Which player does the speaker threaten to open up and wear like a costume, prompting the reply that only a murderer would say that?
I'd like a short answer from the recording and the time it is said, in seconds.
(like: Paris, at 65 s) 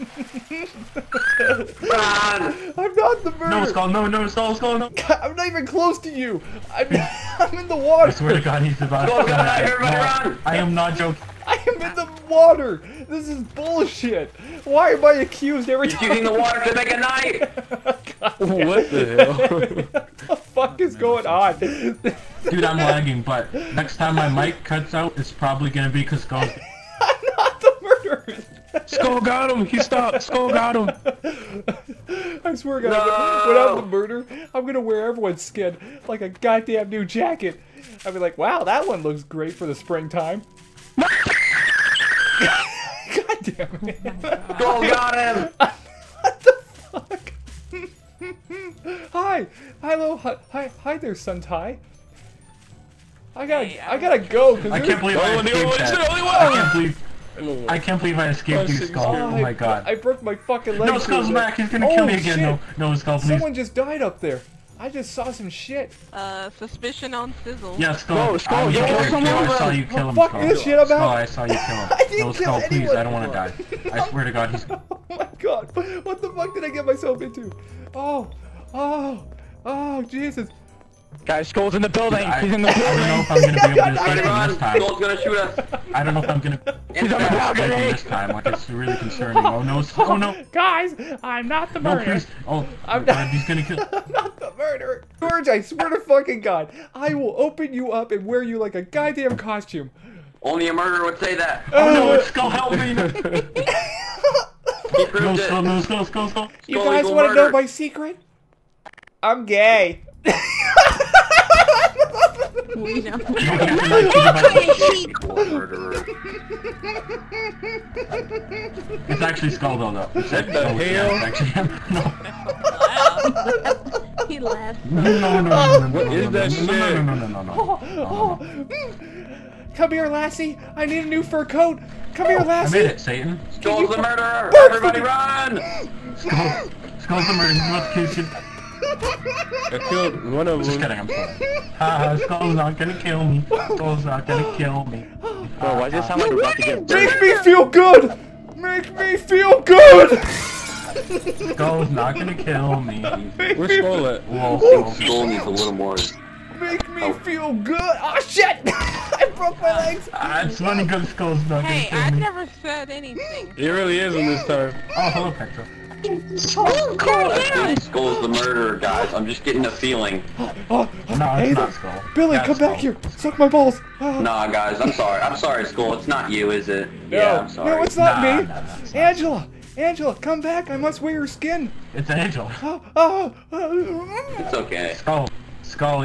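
George, at 95 s.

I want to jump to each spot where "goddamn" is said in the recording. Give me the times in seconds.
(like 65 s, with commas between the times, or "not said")
36 s, 98 s.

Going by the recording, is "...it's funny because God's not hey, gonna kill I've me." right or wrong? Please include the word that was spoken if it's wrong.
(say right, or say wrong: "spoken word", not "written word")
wrong: "Skull", not "God".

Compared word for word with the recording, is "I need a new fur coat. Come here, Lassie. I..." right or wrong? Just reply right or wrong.
right.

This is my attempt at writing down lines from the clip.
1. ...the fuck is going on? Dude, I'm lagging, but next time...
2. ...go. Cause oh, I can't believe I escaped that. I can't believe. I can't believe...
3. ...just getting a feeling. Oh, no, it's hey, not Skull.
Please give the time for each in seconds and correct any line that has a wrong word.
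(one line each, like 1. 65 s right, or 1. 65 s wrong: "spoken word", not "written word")
1. 20 s right
2. 54 s right
3. 169 s right.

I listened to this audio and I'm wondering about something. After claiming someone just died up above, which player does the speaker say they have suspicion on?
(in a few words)
Sizzle.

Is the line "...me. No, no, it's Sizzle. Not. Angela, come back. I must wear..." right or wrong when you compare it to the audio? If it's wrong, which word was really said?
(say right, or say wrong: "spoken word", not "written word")
wrong: "Angela", not "Sizzle".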